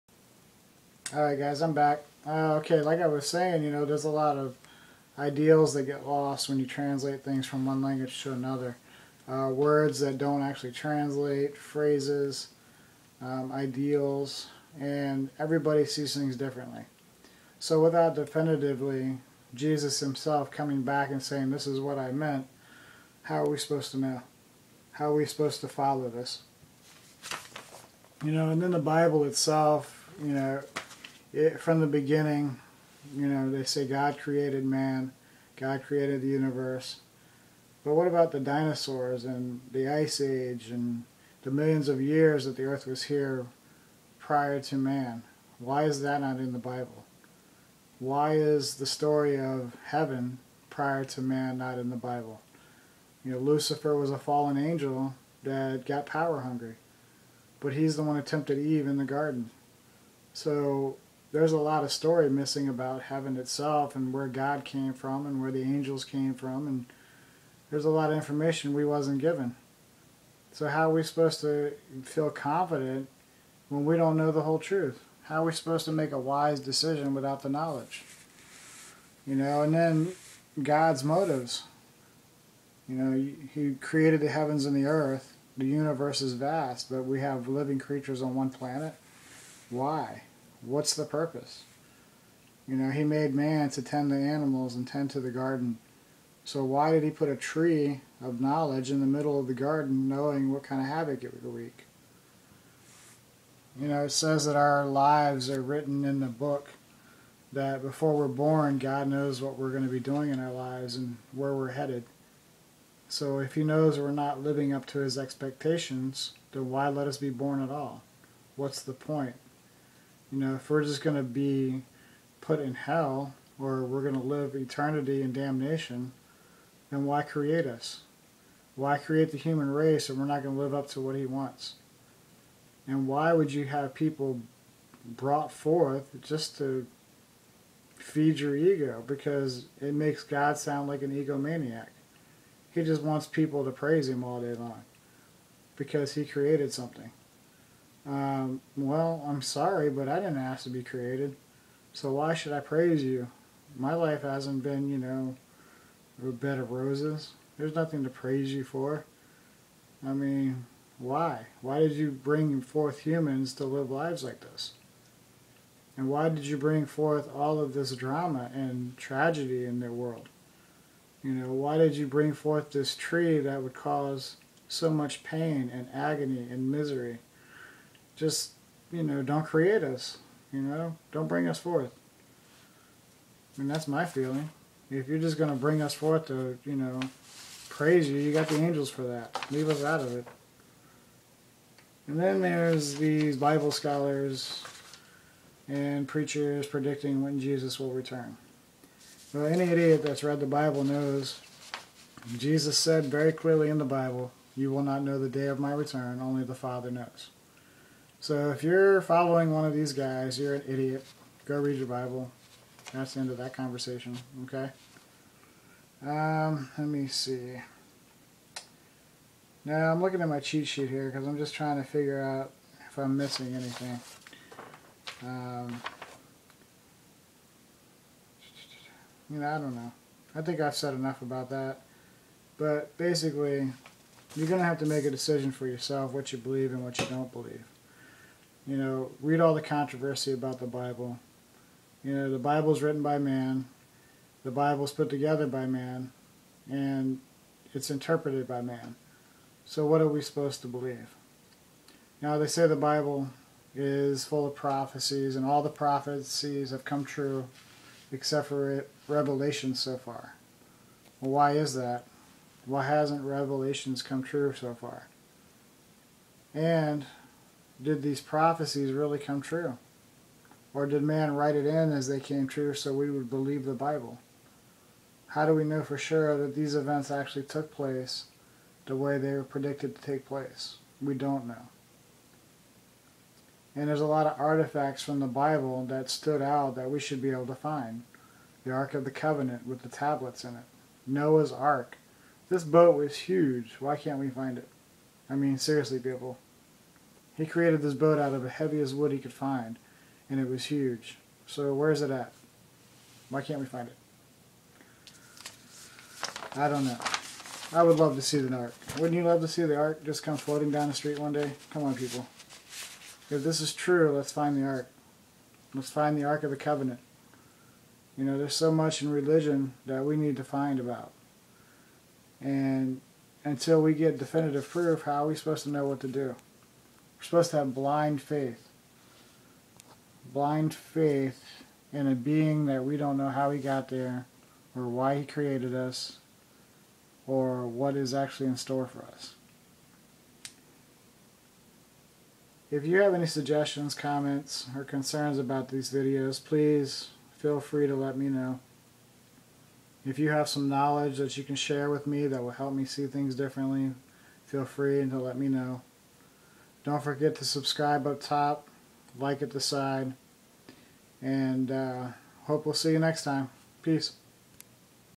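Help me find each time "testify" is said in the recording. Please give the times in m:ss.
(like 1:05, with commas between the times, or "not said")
not said.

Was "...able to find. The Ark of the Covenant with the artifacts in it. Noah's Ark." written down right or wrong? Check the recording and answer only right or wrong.
wrong.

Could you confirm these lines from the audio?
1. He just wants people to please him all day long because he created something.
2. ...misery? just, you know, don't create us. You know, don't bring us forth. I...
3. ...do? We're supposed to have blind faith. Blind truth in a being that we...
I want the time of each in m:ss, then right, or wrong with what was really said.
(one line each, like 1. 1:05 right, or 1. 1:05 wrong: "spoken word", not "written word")
1. 2:22 wrong: "praise", not "please"
2. 2:56 right
3. 5:26 wrong: "faith", not "truth".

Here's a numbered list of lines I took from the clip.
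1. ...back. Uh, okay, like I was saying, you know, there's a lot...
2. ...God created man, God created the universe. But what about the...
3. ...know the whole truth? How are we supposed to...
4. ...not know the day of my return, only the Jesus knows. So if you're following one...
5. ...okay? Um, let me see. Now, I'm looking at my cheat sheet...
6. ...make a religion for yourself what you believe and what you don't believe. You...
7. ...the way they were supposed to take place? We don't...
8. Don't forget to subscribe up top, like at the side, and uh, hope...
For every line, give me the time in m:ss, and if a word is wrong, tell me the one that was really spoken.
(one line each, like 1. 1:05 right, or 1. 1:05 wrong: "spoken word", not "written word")
1. 0:01 right
2. 0:33 right
3. 1:14 right
4. 3:24 wrong: "Father", not "Jesus"
5. 3:34 right
6. 3:54 wrong: "decision", not "religion"
7. 4:38 wrong: "predicted", not "supposed"
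8. 5:56 right.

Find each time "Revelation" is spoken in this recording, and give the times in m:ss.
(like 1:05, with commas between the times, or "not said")
4:19, 4:23.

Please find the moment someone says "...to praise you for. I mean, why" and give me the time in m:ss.
2:38.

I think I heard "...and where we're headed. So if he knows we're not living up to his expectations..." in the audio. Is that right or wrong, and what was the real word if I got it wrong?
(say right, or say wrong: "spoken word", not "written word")
right.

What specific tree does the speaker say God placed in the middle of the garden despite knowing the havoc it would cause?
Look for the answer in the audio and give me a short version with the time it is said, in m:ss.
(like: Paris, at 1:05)
tree of knowledge, at 1:37.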